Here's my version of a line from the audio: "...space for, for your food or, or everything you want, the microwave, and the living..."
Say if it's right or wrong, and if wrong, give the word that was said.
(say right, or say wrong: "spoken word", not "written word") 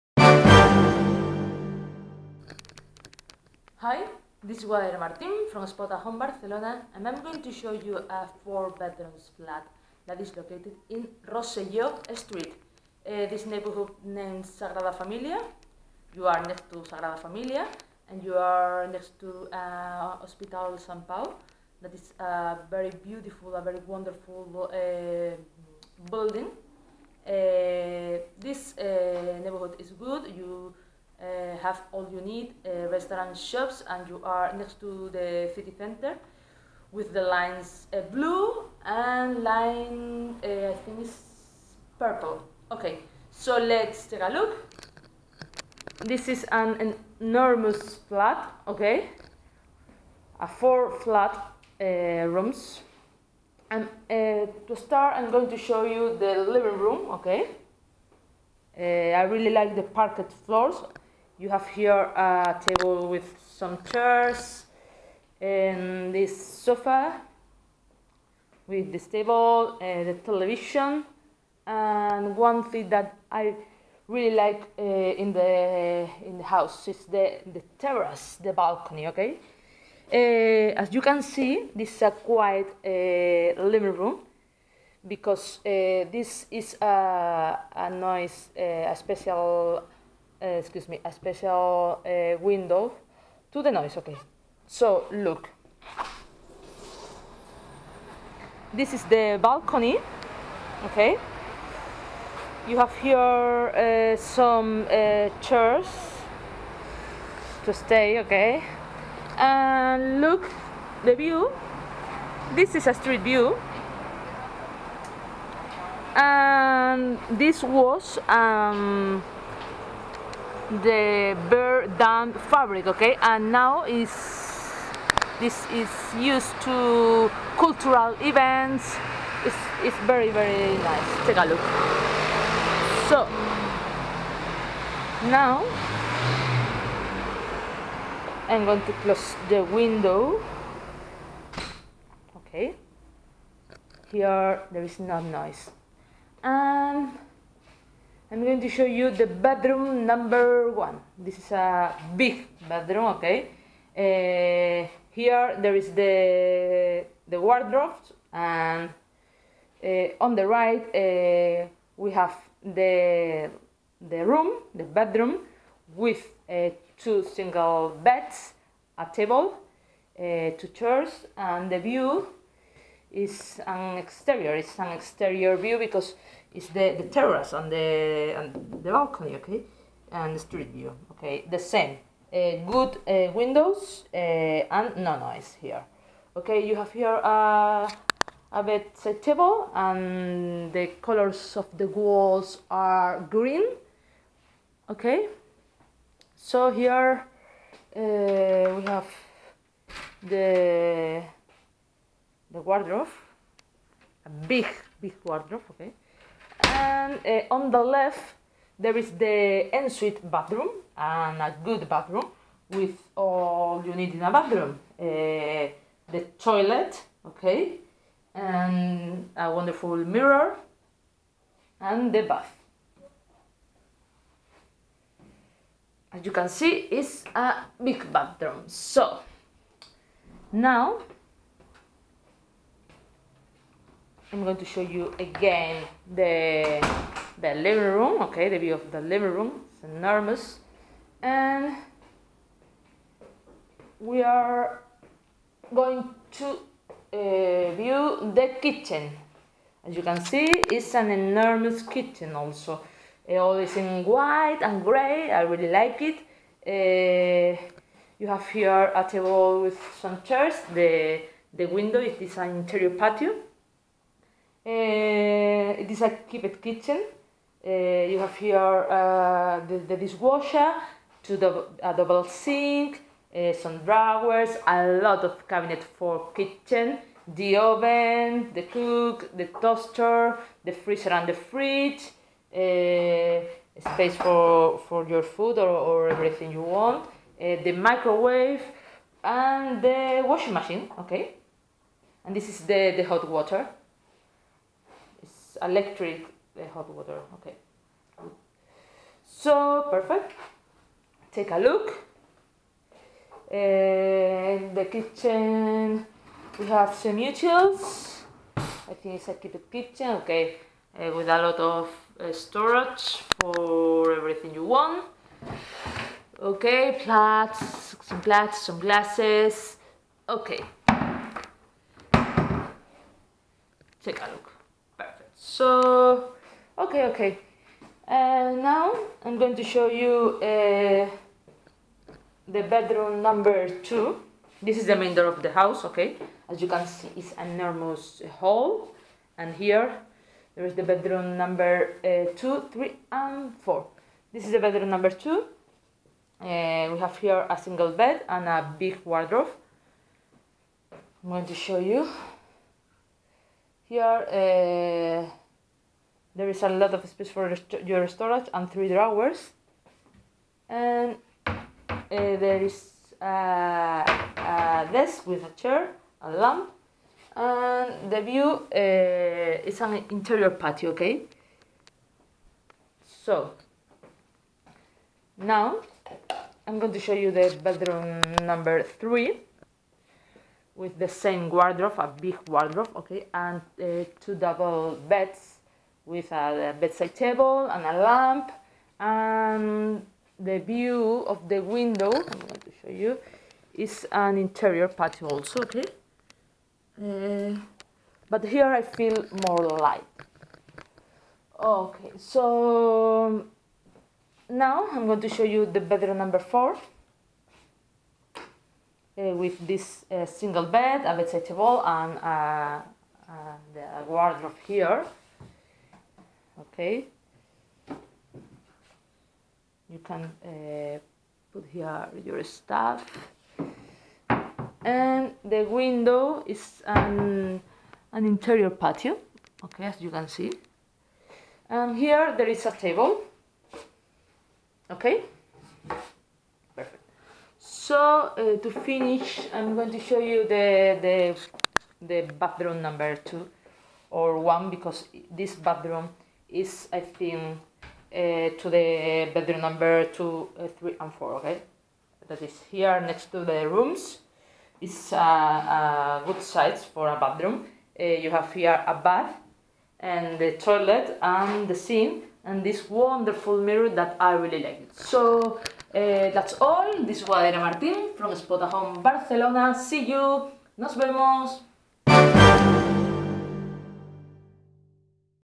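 wrong: "washing", not "living".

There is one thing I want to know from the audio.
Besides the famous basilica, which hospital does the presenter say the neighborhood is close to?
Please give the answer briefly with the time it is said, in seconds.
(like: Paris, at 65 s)
Hospital Sant Pau, at 20 s.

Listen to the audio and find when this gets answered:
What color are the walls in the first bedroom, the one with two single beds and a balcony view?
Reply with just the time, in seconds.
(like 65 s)
193 s.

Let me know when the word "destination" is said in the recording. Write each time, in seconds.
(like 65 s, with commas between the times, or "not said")
not said.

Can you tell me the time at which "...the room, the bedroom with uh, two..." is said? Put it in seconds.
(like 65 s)
164 s.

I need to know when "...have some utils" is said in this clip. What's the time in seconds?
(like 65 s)
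306 s.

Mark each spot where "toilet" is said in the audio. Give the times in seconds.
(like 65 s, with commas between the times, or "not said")
216 s, 460 s.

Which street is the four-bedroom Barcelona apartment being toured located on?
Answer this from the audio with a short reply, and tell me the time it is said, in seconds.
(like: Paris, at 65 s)
Rosselló Street, at 11 s.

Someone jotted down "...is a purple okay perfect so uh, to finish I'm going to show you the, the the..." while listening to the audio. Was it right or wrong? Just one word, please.
wrong.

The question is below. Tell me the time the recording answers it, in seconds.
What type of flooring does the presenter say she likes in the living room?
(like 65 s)
59 s.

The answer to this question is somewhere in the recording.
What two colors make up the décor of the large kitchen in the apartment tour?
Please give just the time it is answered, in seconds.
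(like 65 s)
254 s.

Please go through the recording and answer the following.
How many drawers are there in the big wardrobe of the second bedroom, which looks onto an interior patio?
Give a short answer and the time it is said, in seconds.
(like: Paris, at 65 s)
3, at 358 s.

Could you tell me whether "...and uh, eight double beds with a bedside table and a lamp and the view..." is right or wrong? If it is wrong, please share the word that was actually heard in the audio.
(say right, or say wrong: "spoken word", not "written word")
wrong: "two", not "eight".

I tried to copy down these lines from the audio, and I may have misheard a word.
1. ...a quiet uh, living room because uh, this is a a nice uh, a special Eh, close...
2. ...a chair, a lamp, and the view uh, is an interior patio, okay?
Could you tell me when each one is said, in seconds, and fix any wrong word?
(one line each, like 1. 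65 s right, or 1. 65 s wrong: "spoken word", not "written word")
1. 82 s wrong: "excuse", not "close"
2. 365 s right.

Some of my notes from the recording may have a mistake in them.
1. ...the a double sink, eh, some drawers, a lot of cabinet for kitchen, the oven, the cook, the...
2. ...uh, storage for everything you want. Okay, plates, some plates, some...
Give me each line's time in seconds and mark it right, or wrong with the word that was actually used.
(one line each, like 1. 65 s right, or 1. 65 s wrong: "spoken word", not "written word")
1. 271 s right
2. 312 s right.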